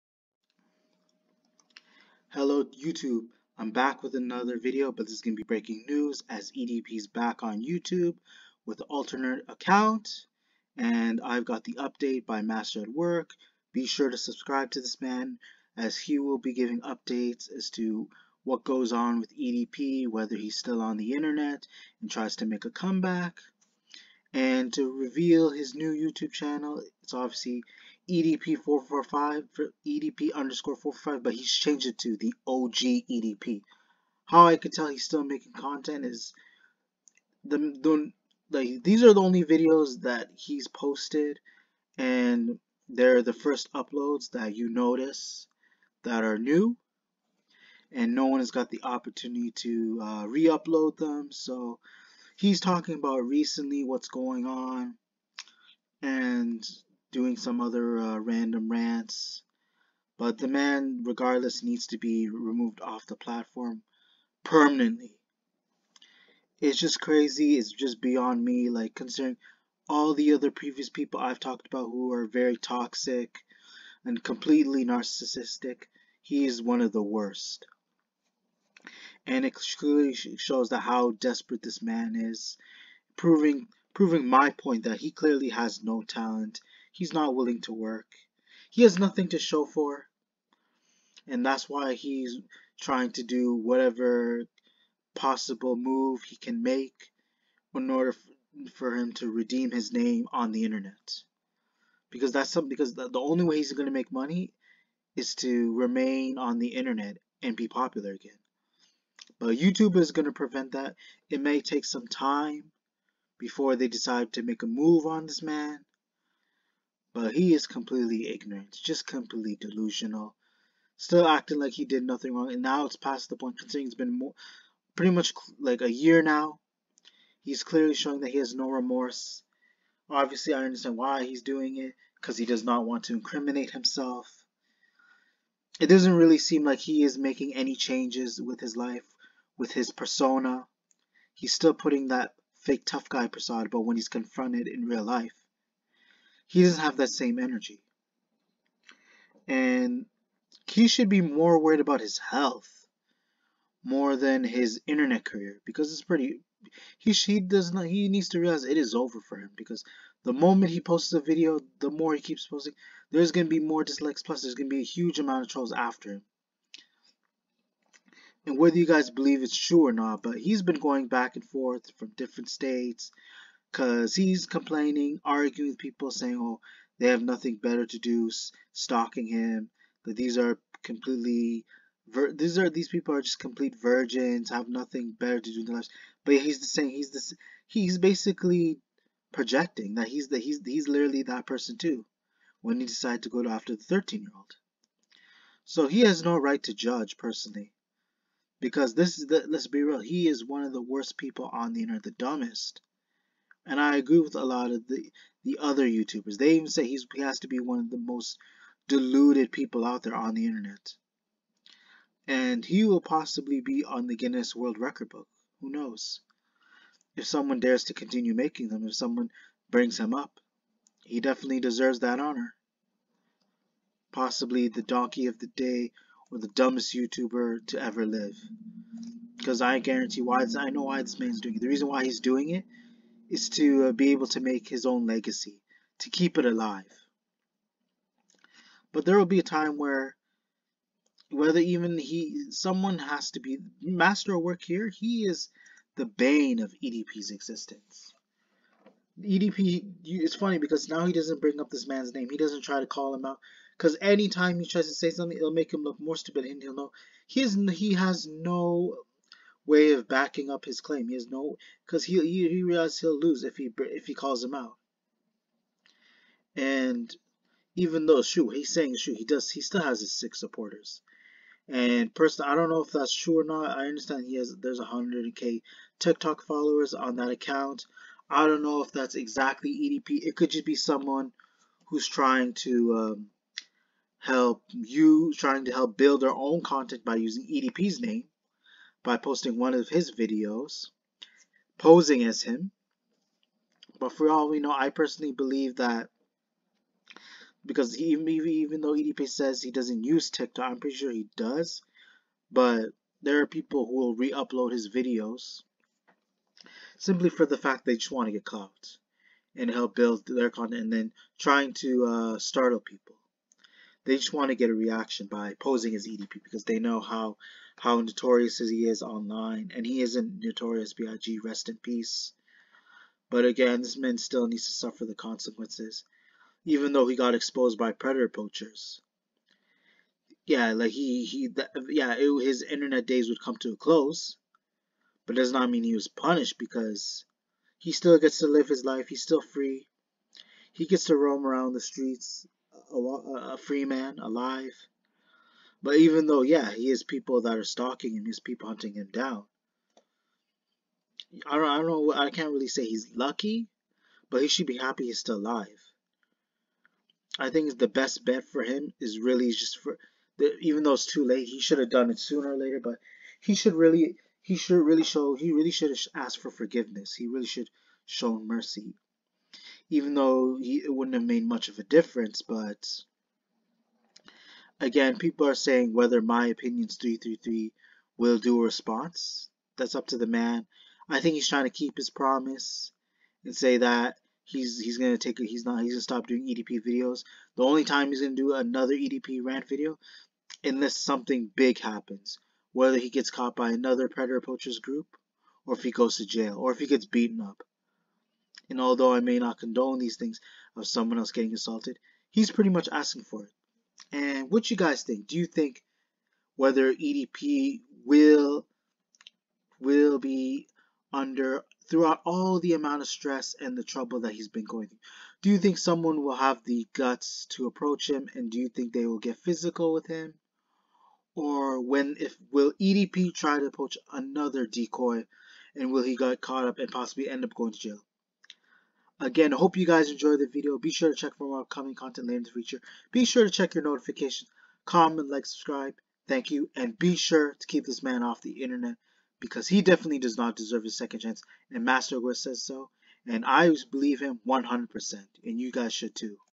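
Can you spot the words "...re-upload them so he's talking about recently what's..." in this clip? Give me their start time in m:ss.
0:50.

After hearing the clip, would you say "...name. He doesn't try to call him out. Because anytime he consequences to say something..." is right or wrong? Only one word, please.
wrong.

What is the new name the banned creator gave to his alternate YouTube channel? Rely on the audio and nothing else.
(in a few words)
OG EDP.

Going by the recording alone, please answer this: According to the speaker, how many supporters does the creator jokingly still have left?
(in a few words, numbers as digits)
6.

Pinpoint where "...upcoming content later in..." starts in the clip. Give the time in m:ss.
7:11.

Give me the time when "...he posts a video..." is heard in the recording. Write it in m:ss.
2:40.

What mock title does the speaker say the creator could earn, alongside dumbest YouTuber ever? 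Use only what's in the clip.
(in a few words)
Donkey of the day.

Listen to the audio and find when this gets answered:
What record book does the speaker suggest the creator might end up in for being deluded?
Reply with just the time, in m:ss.
3:34.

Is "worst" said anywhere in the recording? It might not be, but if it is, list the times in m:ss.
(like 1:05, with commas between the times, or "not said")
1:17, 3:20.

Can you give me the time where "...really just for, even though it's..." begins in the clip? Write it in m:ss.
5:59.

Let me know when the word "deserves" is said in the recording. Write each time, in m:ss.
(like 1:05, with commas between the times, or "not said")
3:41, 7:20.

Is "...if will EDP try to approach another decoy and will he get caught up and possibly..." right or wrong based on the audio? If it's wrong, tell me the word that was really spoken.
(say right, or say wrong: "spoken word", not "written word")
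right.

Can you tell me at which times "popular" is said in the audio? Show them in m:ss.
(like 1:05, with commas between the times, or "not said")
1:47.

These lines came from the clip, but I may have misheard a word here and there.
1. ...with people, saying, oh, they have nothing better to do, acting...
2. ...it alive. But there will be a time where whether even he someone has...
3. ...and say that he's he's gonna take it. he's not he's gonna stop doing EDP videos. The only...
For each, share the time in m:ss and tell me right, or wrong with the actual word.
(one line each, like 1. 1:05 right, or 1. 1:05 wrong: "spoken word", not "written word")
1. 2:55 wrong: "stalking", not "acting"
2. 3:56 right
3. 6:23 right.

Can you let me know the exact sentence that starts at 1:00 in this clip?
But the man, regardless, needs to be removed off the platform permanently.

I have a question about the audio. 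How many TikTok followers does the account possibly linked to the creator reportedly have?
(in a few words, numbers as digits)
100k.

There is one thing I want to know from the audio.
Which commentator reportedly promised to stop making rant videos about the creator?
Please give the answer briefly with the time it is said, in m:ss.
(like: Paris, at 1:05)
My Opinions 333, at 6:16.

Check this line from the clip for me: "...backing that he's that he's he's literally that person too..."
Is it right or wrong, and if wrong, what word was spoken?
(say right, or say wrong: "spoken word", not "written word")
wrong: "projecting", not "backing".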